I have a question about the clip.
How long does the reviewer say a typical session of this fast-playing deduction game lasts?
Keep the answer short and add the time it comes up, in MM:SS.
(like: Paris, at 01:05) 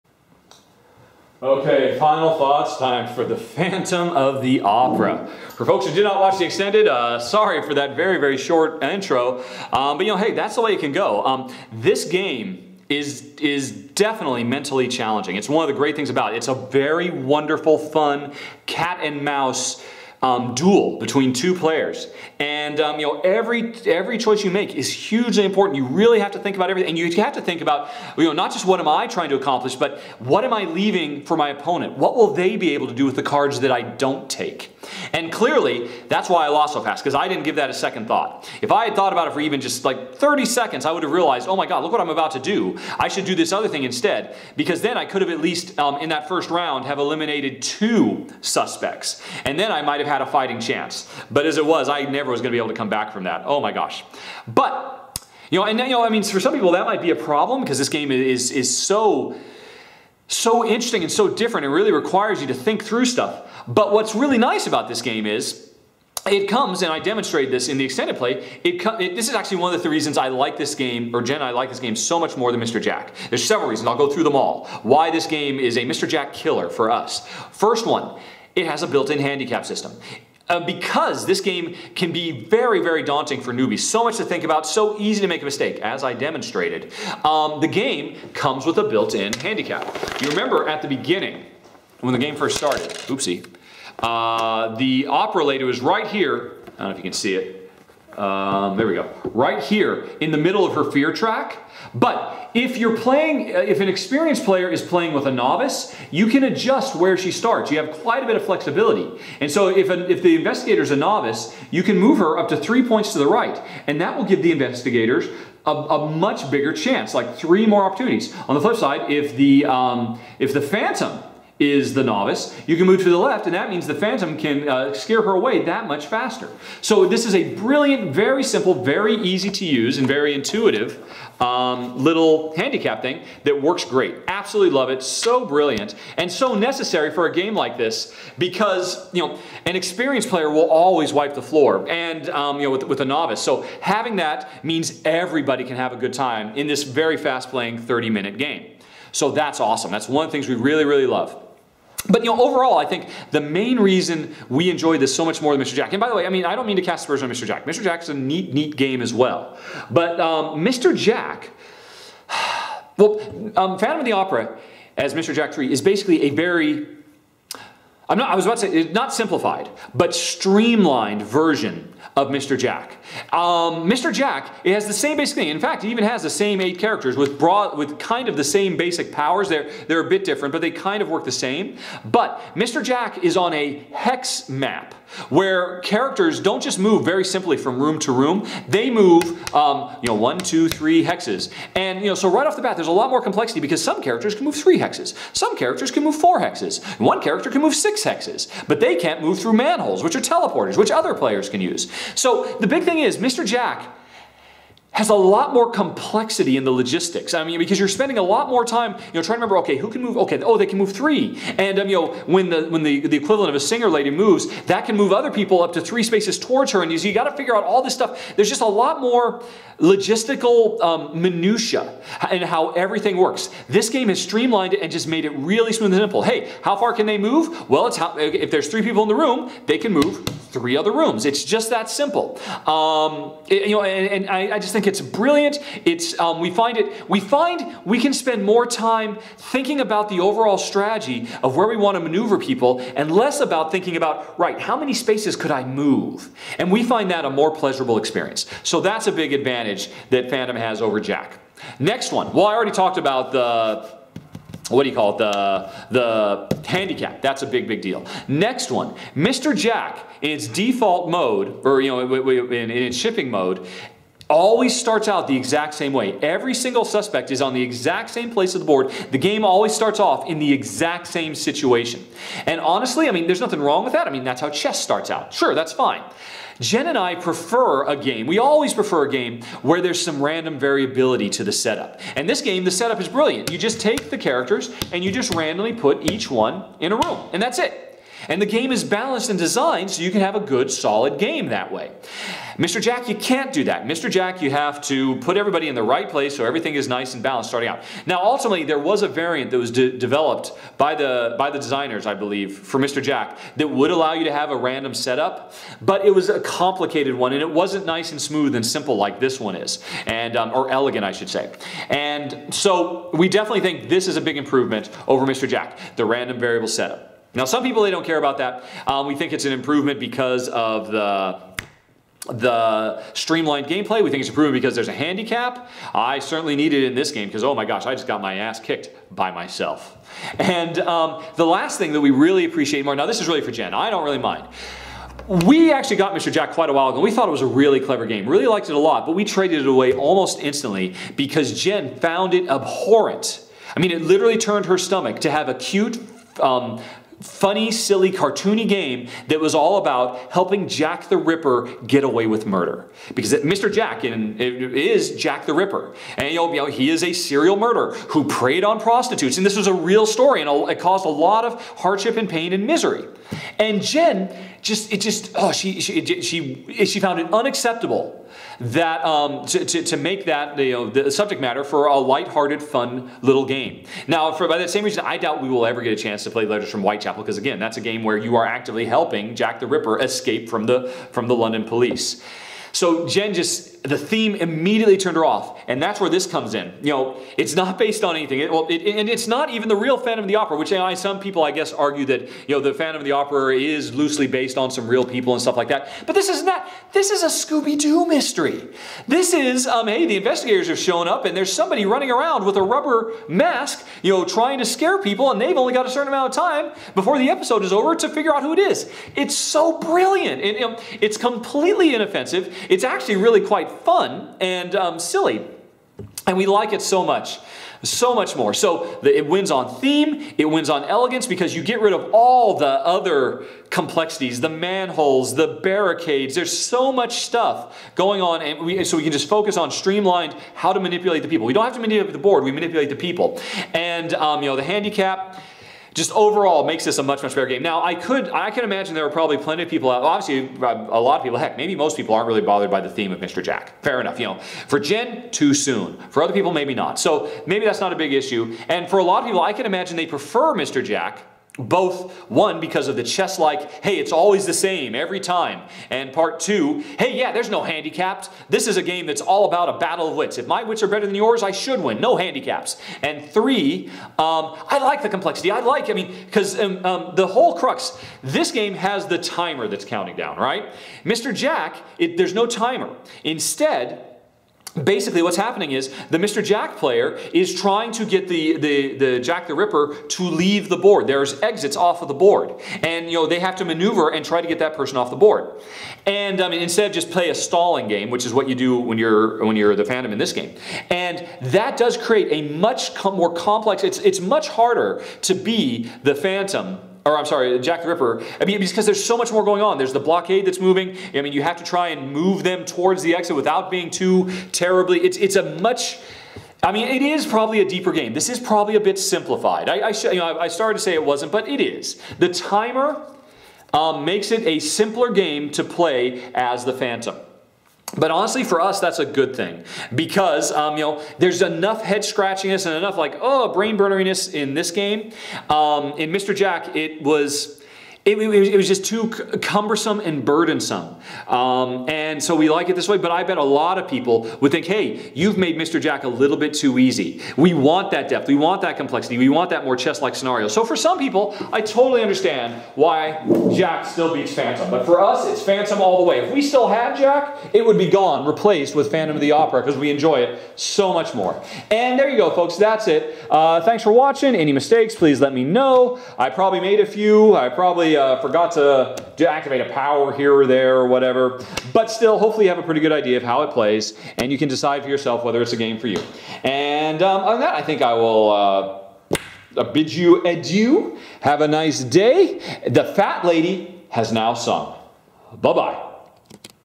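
30 minutes, at 02:27.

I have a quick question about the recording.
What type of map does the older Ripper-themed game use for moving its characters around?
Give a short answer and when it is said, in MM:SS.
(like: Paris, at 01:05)
Hex map, at 03:03.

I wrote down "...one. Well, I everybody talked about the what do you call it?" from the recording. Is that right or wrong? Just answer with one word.
wrong.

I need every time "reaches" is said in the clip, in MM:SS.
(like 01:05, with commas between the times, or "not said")
not said.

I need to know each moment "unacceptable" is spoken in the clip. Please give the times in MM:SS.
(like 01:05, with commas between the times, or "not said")
06:07.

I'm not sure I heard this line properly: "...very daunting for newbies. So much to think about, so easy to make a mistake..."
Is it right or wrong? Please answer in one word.
right.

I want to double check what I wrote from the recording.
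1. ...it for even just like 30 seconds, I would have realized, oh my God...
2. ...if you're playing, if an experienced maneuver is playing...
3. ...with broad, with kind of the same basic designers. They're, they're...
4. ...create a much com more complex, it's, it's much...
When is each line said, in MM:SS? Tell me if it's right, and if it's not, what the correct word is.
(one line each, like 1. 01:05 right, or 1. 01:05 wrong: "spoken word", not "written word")
1. 00:39 right
2. 01:42 wrong: "player", not "maneuver"
3. 02:57 wrong: "powers", not "designers"
4. 08:11 right.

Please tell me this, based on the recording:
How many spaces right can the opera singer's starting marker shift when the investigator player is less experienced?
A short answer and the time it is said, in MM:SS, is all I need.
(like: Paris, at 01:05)
3, at 01:52.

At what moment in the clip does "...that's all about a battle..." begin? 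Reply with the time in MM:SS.
07:39.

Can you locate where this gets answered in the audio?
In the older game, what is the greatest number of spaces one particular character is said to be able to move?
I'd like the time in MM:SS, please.
03:17.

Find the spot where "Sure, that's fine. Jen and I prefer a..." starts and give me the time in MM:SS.
04:35.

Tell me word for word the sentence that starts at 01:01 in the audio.
It really requires you to think through stuff.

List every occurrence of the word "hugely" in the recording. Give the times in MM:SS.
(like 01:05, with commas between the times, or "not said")
00:24.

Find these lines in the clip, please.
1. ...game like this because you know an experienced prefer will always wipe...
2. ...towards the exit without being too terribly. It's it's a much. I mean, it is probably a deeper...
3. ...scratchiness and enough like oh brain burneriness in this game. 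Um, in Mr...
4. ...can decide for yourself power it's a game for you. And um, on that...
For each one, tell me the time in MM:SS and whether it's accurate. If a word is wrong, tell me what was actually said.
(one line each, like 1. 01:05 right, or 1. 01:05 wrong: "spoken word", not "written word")
1. 02:17 wrong: "player", not "prefer"
2. 08:22 right
3. 08:42 right
4. 09:24 wrong: "whether", not "power".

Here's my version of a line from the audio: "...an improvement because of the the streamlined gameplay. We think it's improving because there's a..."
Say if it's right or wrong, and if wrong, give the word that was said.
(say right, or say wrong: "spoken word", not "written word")
right.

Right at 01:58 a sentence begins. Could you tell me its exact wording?
On the flip side, if the um, if the phantom is the novice.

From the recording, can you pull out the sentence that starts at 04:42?
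And this game, the setup is brilliant.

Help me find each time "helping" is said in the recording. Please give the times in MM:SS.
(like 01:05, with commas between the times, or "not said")
05:50, 06:18.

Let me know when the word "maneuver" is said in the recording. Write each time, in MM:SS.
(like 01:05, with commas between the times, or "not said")
04:01, 08:03.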